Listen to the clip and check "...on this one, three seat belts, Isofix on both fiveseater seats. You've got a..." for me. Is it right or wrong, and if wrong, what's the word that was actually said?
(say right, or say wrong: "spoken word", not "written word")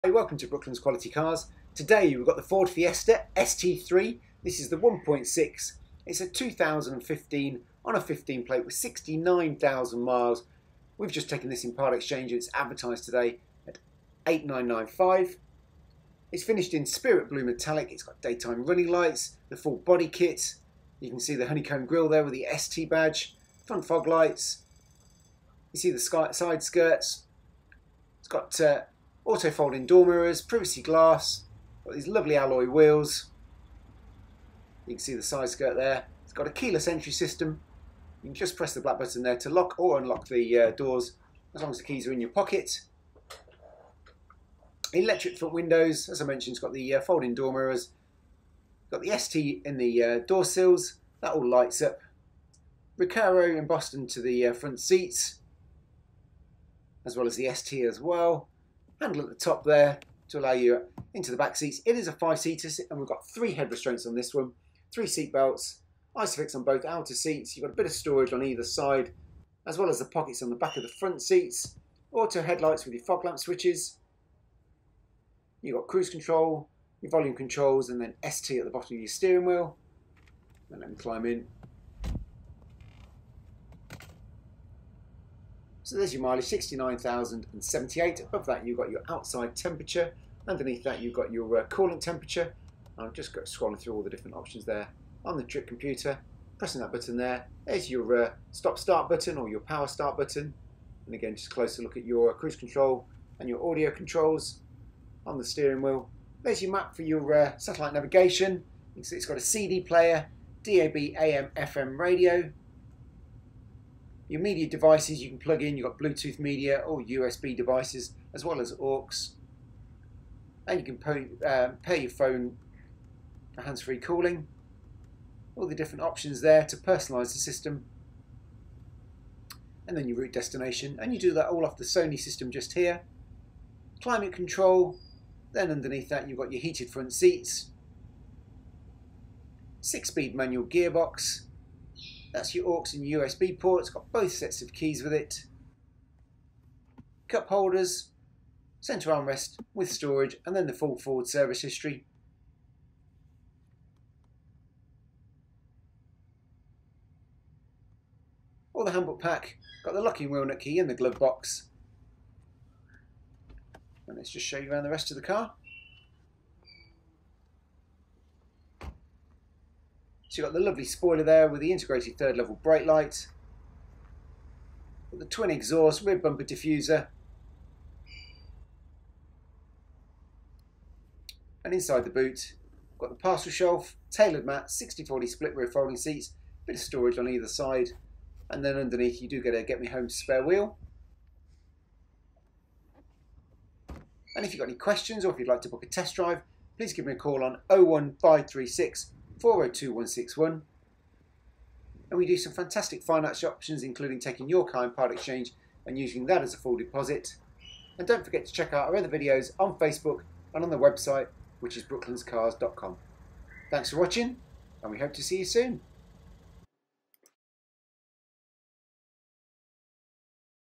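wrong: "outer", not "fiveseater".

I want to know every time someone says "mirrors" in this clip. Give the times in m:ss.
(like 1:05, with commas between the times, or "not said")
0:30, 0:47.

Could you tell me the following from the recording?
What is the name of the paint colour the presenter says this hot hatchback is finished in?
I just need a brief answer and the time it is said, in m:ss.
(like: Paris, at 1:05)
Spirit Blue Metallic, at 0:16.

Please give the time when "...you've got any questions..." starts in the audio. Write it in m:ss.
3:14.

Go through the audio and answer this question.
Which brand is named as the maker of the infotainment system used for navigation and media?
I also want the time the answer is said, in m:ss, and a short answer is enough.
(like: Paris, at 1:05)
Sony, at 2:11.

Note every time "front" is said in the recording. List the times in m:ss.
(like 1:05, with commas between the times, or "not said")
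0:23, 0:45, 0:54, 1:10, 2:16.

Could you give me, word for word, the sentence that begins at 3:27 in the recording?
And don't forget to check out our other videos on Facebook and on the website which is brooklandscars.com.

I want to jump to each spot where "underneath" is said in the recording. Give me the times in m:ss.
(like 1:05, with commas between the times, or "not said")
1:30, 2:15, 3:08.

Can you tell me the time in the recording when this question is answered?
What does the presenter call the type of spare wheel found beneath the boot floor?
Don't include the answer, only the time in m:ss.
3:09.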